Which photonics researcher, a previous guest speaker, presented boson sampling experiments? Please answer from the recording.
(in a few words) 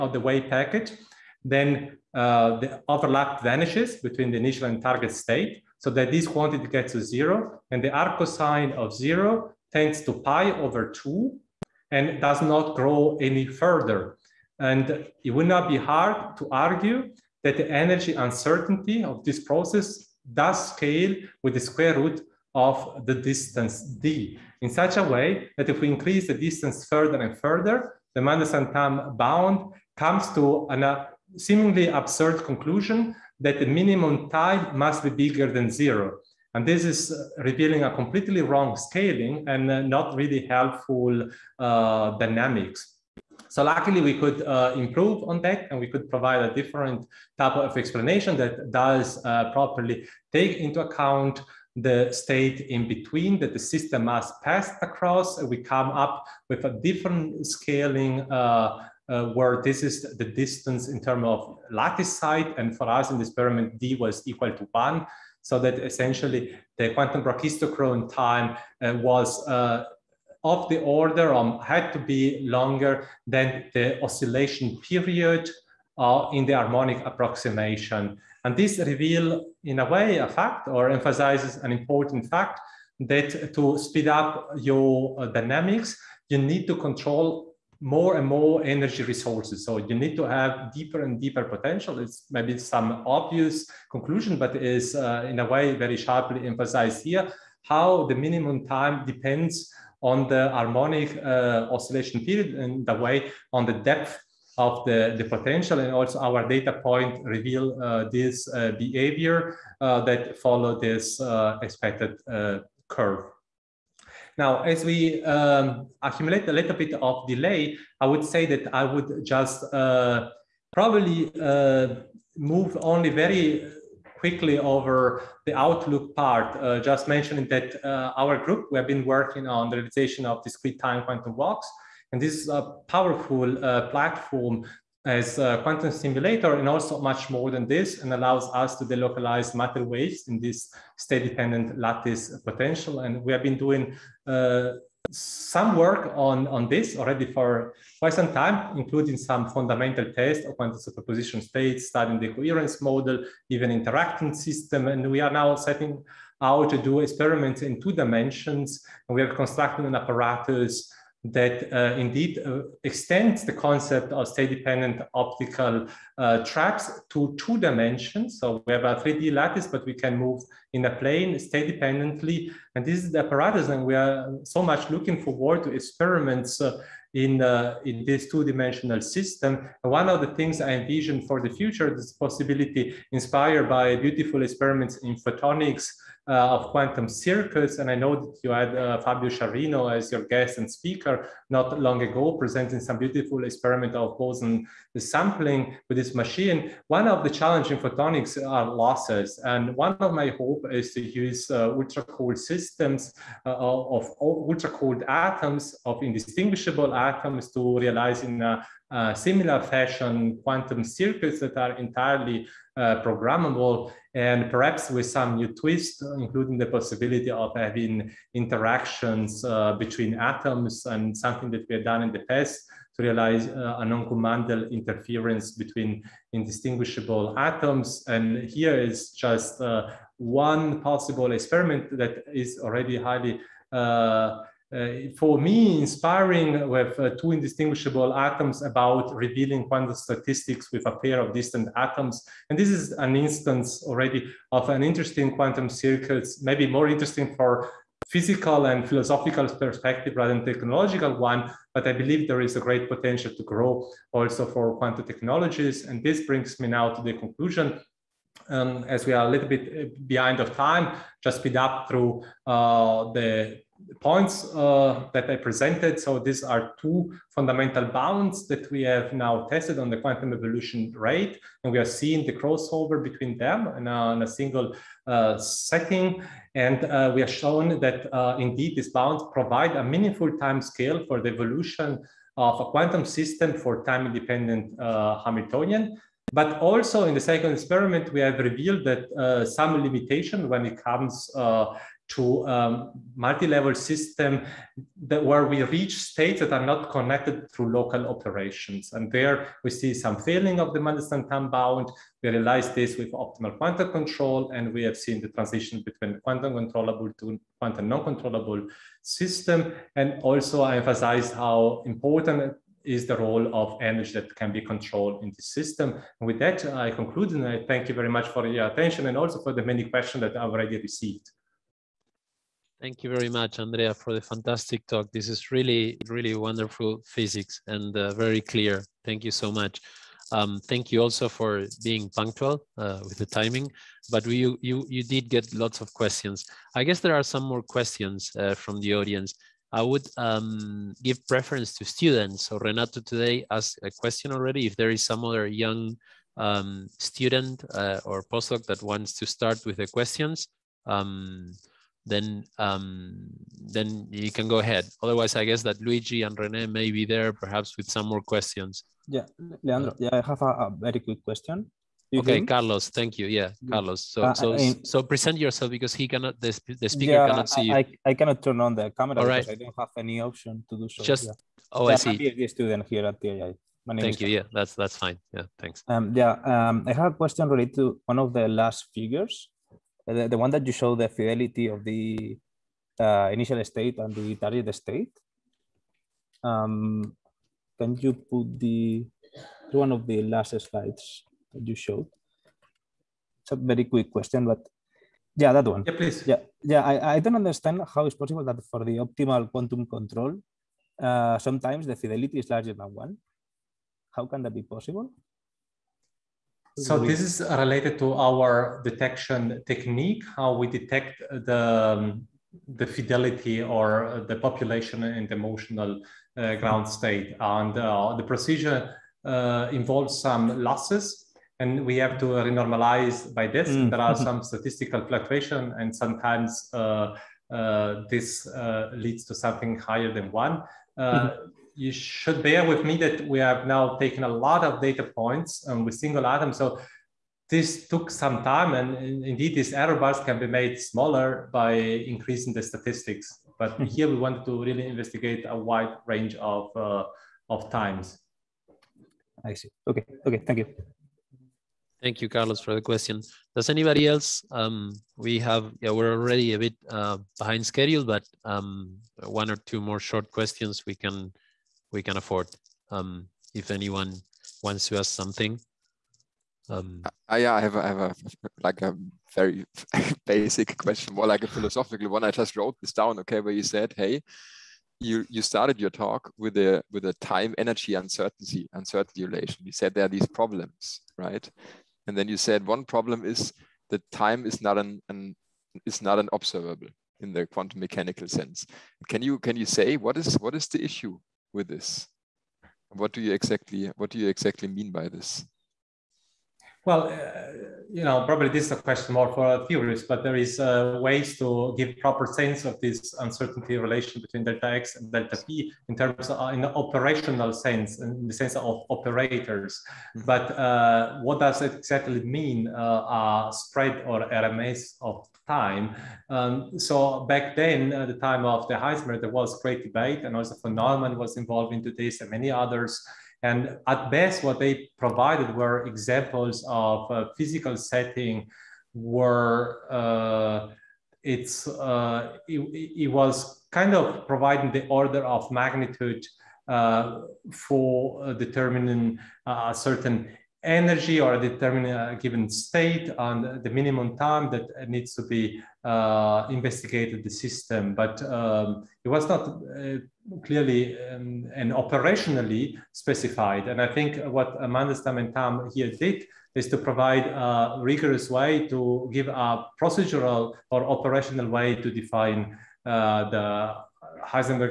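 Fabio Sciarrino.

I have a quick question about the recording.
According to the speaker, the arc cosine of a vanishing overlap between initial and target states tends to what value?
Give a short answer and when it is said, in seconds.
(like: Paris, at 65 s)
pi/2, at 10 s.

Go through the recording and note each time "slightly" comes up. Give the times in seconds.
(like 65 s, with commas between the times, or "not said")
not said.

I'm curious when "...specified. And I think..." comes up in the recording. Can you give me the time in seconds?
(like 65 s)
552 s.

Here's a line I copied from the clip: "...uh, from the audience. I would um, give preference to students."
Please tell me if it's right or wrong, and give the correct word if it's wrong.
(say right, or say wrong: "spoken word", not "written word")
right.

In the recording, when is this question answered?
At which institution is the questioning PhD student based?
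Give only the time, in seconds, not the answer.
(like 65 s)
373 s.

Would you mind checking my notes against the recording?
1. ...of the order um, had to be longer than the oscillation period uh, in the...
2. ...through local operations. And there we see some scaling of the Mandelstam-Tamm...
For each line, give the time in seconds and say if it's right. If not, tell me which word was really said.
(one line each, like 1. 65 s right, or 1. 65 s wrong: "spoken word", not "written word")
1. 70 s right
2. 297 s wrong: "failing", not "scaling".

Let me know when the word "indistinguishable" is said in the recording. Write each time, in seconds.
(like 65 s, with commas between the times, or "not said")
206 s, 226 s, 237 s.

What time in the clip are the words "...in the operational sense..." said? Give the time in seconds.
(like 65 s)
506 s.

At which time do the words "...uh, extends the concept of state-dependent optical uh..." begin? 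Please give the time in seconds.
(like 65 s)
162 s.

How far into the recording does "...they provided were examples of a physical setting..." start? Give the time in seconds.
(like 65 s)
524 s.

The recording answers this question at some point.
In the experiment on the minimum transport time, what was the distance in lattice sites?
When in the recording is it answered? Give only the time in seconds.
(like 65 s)
63 s.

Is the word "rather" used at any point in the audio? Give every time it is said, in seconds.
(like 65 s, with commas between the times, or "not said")
250 s.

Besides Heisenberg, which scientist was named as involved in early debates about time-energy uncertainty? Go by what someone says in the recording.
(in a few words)
Neumann.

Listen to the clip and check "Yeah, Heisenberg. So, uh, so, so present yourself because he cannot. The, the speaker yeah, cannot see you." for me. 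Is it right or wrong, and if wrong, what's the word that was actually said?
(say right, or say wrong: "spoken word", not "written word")
wrong: "Carlos", not "Heisenberg".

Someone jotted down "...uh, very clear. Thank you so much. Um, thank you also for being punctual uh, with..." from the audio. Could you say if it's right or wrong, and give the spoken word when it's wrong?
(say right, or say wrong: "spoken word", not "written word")
right.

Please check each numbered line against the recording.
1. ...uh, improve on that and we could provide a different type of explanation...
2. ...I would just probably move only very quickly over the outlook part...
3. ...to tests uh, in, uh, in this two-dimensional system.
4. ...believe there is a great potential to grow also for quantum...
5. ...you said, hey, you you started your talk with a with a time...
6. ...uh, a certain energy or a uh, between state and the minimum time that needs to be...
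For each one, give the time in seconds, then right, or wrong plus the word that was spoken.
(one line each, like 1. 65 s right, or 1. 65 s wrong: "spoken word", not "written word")
1. 44 s right
2. 118 s right
3. 175 s wrong: "experiments", not "tests"
4. 251 s right
5. 473 s right
6. 539 s wrong: "given", not "between".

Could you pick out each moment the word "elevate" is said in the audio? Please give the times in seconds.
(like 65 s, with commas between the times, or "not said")
not said.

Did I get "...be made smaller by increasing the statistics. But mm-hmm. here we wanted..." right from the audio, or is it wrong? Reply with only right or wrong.
right.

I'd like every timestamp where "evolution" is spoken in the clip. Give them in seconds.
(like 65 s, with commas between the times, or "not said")
270 s, 281 s.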